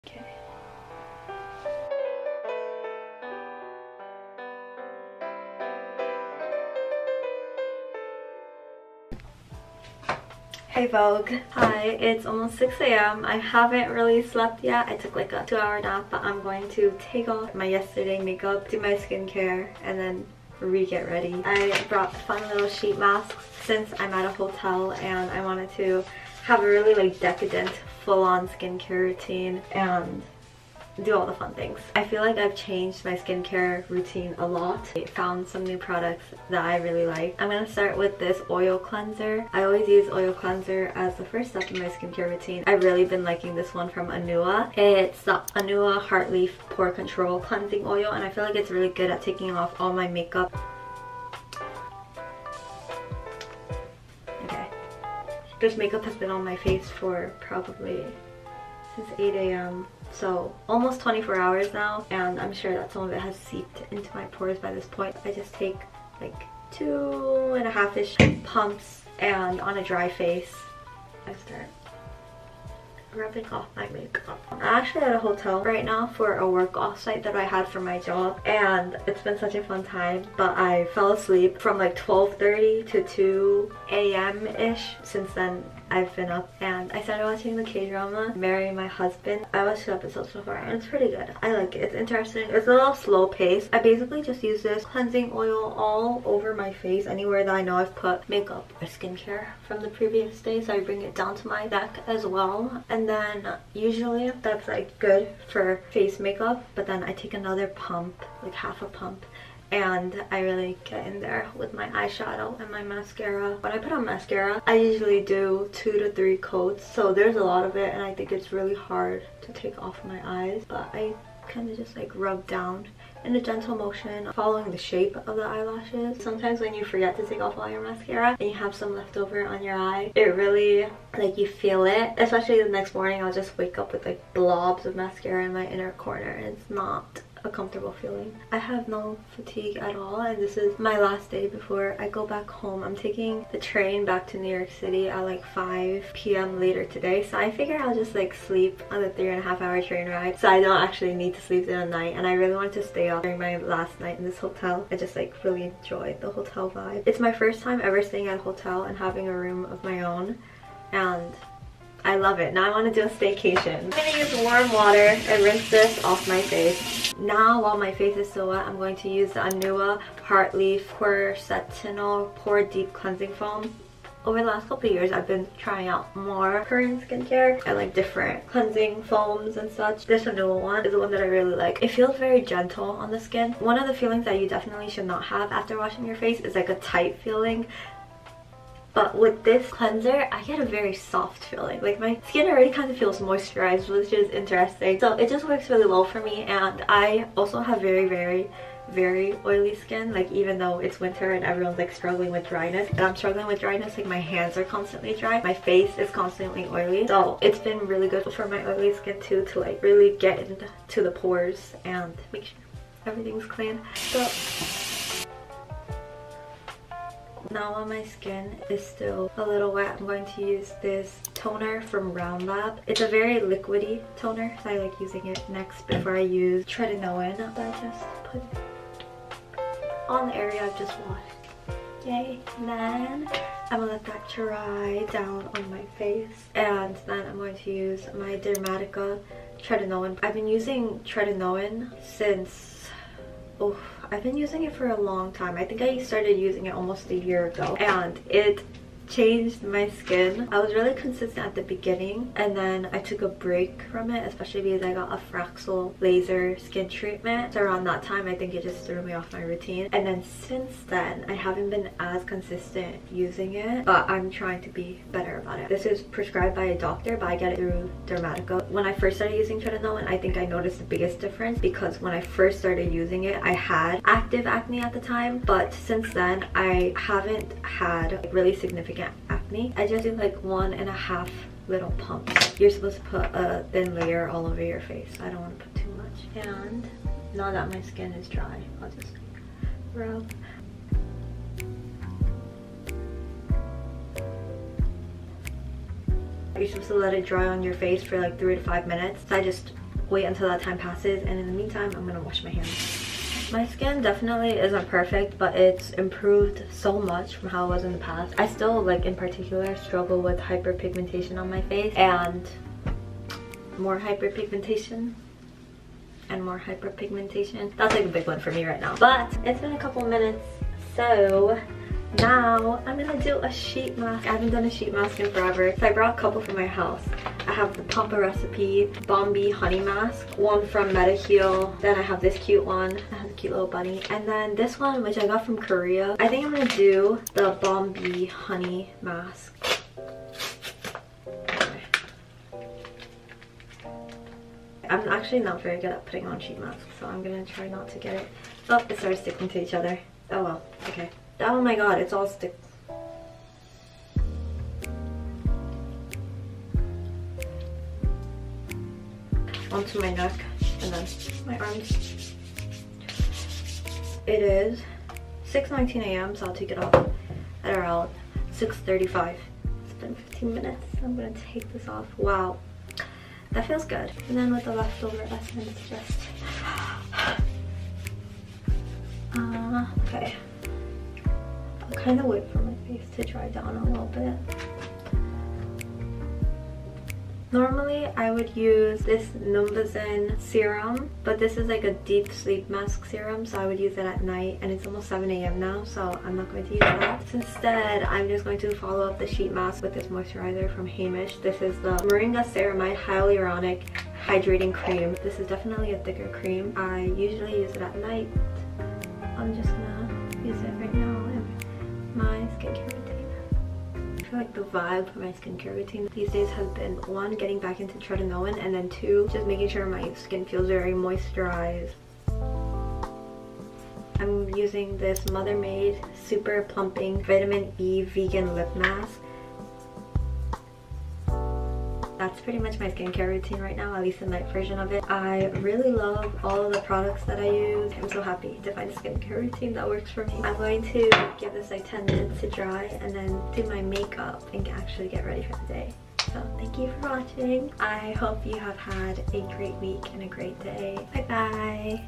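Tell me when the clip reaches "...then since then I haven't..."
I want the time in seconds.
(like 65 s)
260 s.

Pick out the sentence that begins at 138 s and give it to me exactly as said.
I have no fatigue at all and this is my last day before I go back home.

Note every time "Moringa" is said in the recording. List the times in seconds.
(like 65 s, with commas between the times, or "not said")
402 s.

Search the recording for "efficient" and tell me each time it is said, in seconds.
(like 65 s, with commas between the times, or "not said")
not said.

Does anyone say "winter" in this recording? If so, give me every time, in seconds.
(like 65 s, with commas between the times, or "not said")
200 s.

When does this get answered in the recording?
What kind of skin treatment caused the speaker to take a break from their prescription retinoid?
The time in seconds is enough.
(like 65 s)
255 s.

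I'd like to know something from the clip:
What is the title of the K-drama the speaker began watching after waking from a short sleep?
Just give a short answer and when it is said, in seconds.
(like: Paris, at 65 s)
Marry My Husband, at 88 s.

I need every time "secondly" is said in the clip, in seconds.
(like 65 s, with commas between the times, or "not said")
not said.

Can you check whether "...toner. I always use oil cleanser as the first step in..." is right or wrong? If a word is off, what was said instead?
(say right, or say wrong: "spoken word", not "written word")
wrong: "cleanser", not "toner".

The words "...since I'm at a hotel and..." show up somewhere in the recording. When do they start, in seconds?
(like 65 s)
23 s.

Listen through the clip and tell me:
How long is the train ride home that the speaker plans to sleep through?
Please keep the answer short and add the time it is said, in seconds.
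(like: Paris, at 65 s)
3.5 hours, at 149 s.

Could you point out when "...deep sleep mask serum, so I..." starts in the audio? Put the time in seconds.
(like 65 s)
392 s.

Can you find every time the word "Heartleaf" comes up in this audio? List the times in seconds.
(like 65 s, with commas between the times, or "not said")
46 s, 170 s.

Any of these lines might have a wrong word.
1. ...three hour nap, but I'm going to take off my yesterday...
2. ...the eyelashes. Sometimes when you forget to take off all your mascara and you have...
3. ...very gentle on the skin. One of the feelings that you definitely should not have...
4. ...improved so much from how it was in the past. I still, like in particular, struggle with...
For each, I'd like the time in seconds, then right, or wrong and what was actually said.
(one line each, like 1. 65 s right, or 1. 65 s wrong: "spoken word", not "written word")
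1. 15 s wrong: "two", not "three"
2. 125 s right
3. 182 s right
4. 305 s right.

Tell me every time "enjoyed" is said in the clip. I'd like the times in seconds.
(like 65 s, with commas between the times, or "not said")
155 s.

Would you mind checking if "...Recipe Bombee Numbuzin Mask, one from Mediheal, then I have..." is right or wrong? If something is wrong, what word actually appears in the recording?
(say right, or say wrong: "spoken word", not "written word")
wrong: "Honey", not "Numbuzin".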